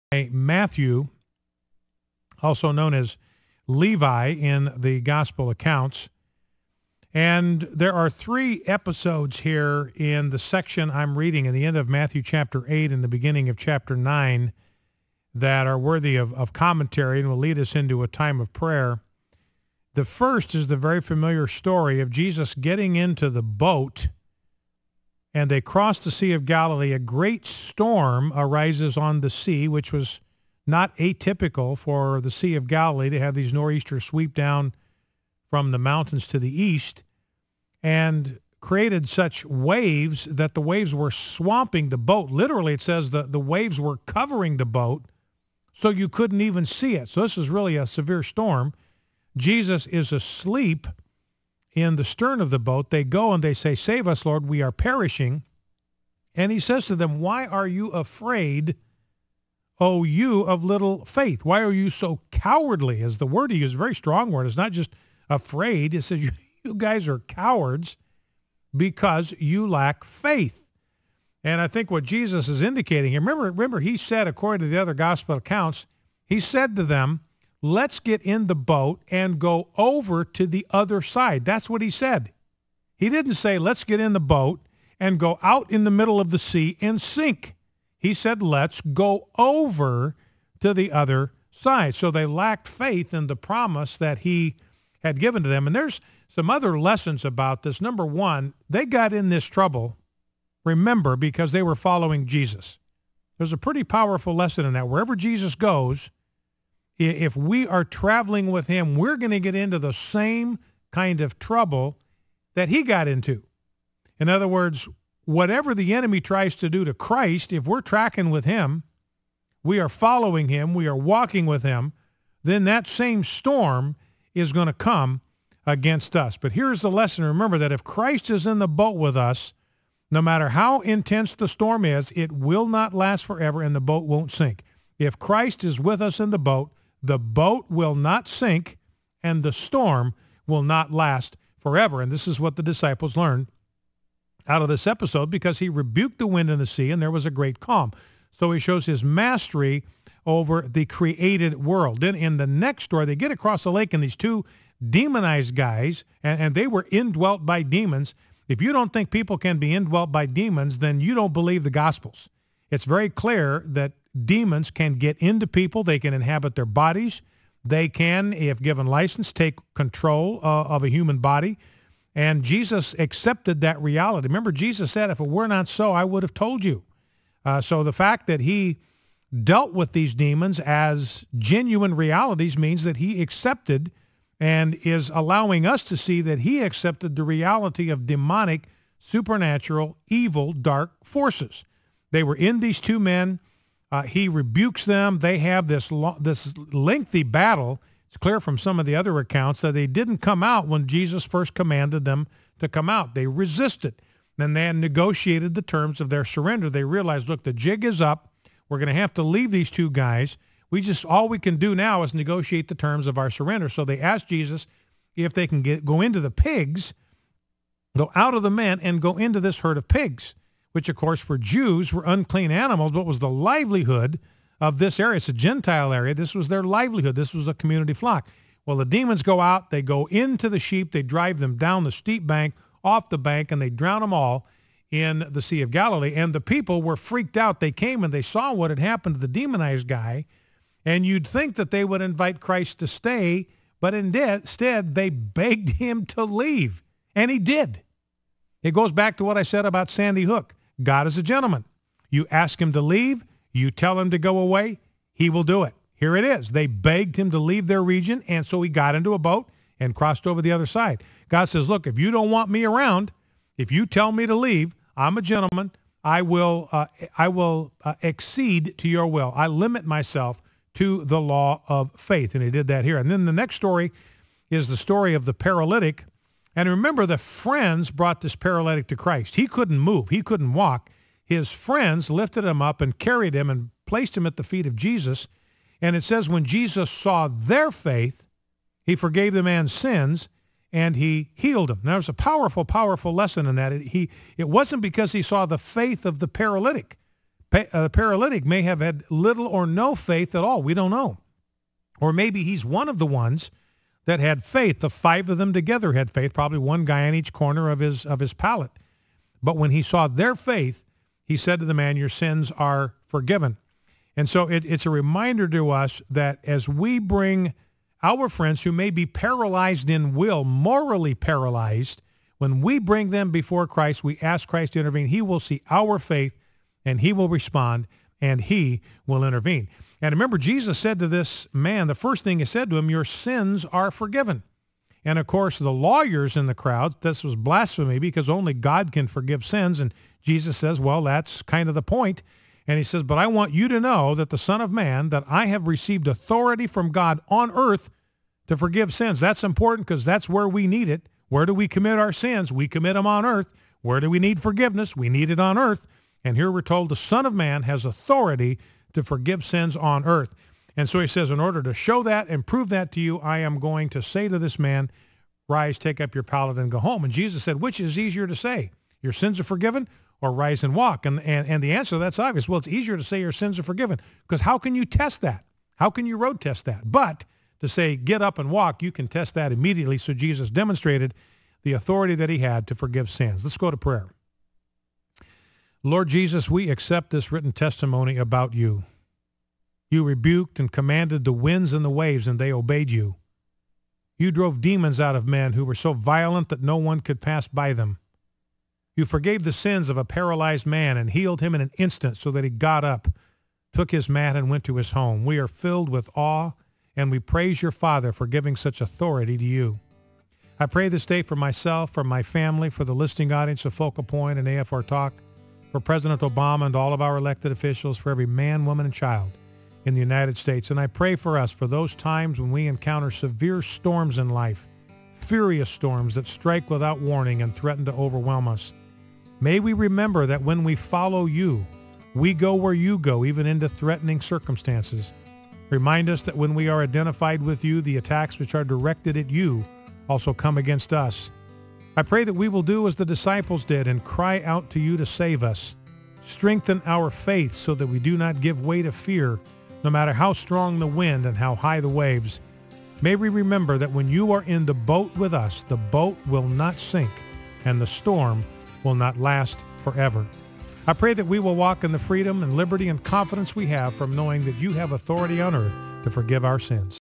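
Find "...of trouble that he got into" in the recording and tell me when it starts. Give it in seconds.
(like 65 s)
111 s.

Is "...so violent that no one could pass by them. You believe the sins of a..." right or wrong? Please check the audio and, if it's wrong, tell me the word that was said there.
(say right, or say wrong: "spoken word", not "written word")
wrong: "forgave", not "believe".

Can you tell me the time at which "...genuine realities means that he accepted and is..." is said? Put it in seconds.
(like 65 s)
181 s.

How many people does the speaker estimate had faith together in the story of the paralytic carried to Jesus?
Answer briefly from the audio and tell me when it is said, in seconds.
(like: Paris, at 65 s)
5, at 304 s.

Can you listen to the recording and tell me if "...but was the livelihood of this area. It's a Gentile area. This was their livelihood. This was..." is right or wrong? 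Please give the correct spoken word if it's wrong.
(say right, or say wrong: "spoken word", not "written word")
right.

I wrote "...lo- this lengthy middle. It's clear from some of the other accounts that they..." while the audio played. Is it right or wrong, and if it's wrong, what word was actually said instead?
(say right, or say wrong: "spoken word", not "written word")
wrong: "battle", not "middle".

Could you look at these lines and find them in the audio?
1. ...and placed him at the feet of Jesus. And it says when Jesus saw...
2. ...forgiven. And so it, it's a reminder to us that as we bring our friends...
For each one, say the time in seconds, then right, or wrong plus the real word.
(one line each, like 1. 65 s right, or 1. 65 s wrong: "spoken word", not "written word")
1. 283 s right
2. 313 s right.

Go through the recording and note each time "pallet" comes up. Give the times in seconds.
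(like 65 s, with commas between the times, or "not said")
308 s, 366 s.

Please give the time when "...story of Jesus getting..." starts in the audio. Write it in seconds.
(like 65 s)
21 s.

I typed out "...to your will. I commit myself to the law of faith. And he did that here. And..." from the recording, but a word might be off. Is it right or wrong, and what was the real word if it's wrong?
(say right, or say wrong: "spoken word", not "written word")
wrong: "limit", not "commit".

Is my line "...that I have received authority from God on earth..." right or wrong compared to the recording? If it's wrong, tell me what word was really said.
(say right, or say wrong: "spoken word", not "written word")
right.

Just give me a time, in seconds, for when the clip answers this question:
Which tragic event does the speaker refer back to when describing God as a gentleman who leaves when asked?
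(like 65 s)
249 s.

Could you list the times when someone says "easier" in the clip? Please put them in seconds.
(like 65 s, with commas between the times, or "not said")
367 s, 372 s.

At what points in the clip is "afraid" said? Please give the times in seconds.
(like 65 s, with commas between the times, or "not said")
57 s, 65 s.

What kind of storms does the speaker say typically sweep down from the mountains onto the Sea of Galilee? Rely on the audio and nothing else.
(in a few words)
Nor'easters.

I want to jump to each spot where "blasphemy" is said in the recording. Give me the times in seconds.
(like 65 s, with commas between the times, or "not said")
337 s.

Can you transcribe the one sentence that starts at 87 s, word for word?
He said, let's go over to the other side.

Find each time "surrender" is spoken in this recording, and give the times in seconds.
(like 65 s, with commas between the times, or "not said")
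206 s, 213 s.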